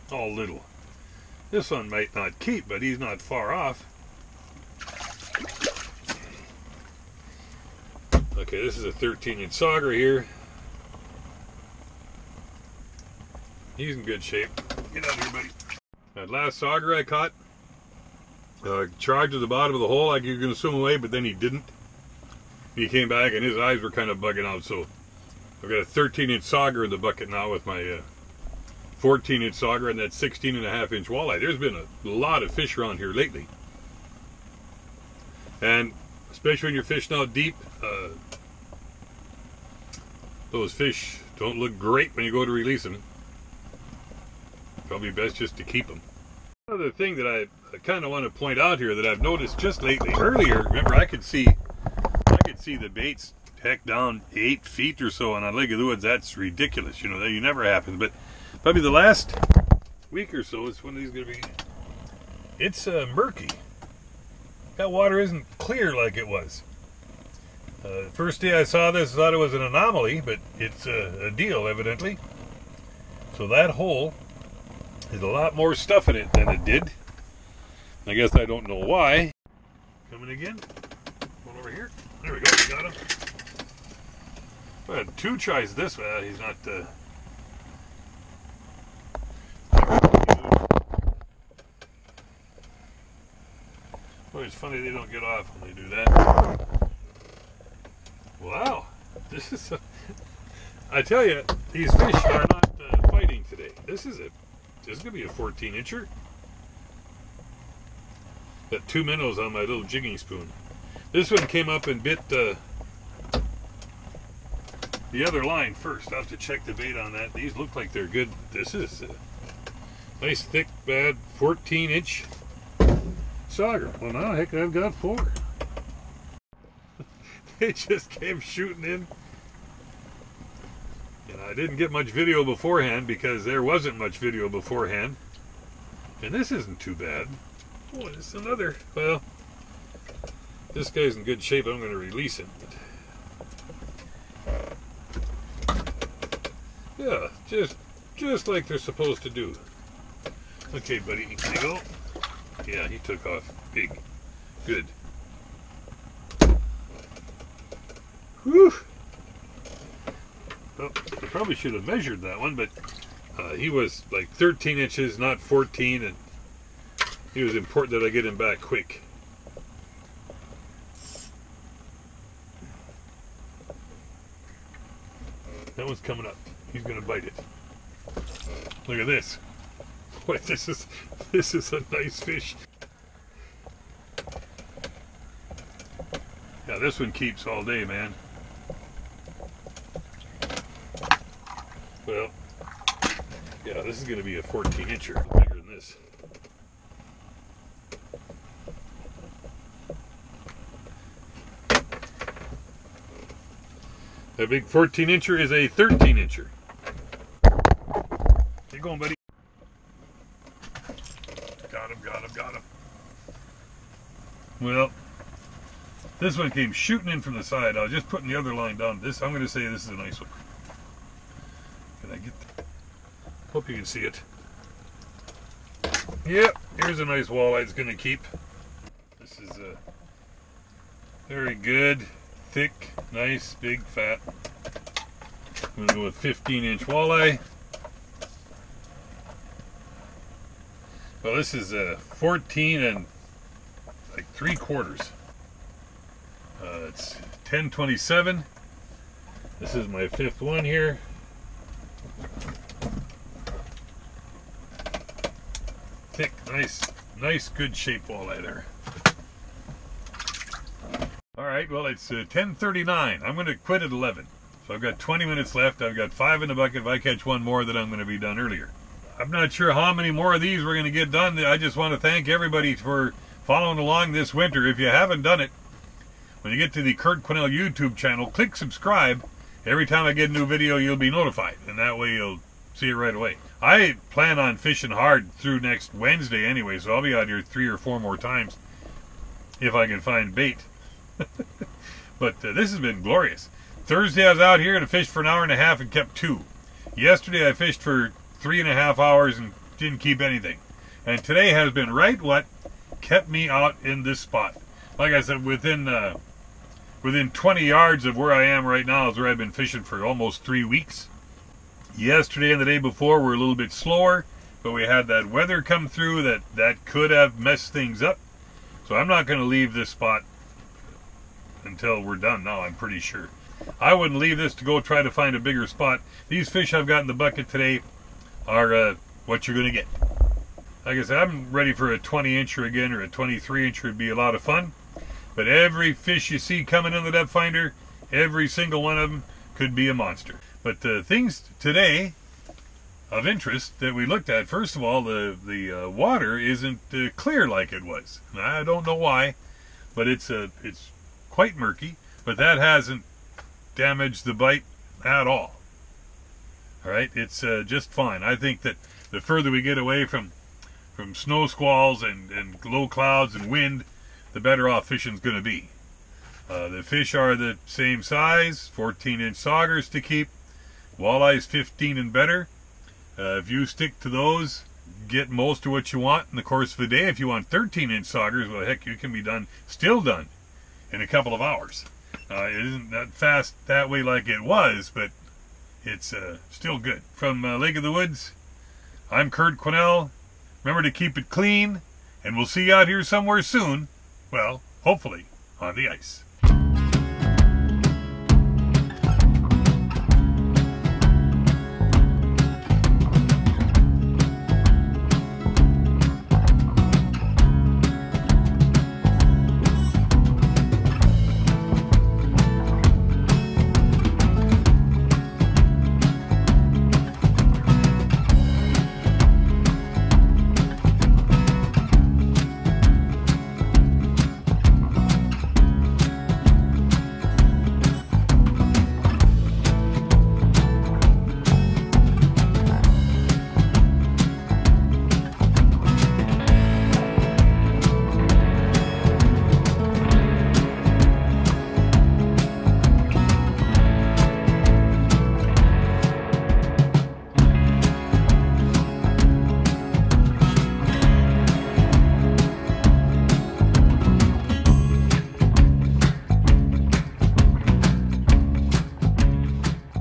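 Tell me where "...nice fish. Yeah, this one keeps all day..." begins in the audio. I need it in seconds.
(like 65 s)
181 s.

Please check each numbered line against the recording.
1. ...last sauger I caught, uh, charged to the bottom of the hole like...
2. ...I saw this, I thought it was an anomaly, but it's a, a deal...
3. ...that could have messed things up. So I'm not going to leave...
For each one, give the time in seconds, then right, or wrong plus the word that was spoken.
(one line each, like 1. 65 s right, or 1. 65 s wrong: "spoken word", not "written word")
1. 16 s right
2. 68 s right
3. 316 s right.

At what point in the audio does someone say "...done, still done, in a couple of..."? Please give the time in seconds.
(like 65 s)
379 s.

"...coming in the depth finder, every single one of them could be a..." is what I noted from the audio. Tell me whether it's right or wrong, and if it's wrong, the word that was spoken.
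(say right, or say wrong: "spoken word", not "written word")
right.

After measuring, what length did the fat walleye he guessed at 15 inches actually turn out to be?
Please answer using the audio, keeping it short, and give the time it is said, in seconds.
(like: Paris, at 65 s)
14 and three quarters inches, at 241 s.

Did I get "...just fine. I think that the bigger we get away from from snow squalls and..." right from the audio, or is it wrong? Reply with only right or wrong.
wrong.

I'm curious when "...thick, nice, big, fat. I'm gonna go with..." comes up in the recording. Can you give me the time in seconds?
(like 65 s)
232 s.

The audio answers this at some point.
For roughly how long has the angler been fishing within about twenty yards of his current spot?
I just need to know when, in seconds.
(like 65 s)
310 s.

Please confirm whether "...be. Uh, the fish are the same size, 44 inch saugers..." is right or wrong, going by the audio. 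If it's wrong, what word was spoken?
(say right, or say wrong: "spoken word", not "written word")
wrong: "14", not "44".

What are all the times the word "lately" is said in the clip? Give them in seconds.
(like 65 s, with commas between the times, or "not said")
33 s, 49 s.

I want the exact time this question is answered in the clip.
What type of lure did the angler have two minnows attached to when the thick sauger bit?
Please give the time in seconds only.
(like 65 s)
109 s.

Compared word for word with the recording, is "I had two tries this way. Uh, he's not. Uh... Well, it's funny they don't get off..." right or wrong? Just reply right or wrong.
right.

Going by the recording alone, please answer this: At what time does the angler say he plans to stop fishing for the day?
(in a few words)
11.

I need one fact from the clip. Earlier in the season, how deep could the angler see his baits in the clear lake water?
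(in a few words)
8 feet.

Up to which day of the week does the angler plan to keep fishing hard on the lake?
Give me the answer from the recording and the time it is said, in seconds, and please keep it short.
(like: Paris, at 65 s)
Wednesday, at 285 s.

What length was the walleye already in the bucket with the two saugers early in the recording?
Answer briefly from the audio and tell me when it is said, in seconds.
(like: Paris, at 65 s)
16 and a half inches, at 30 s.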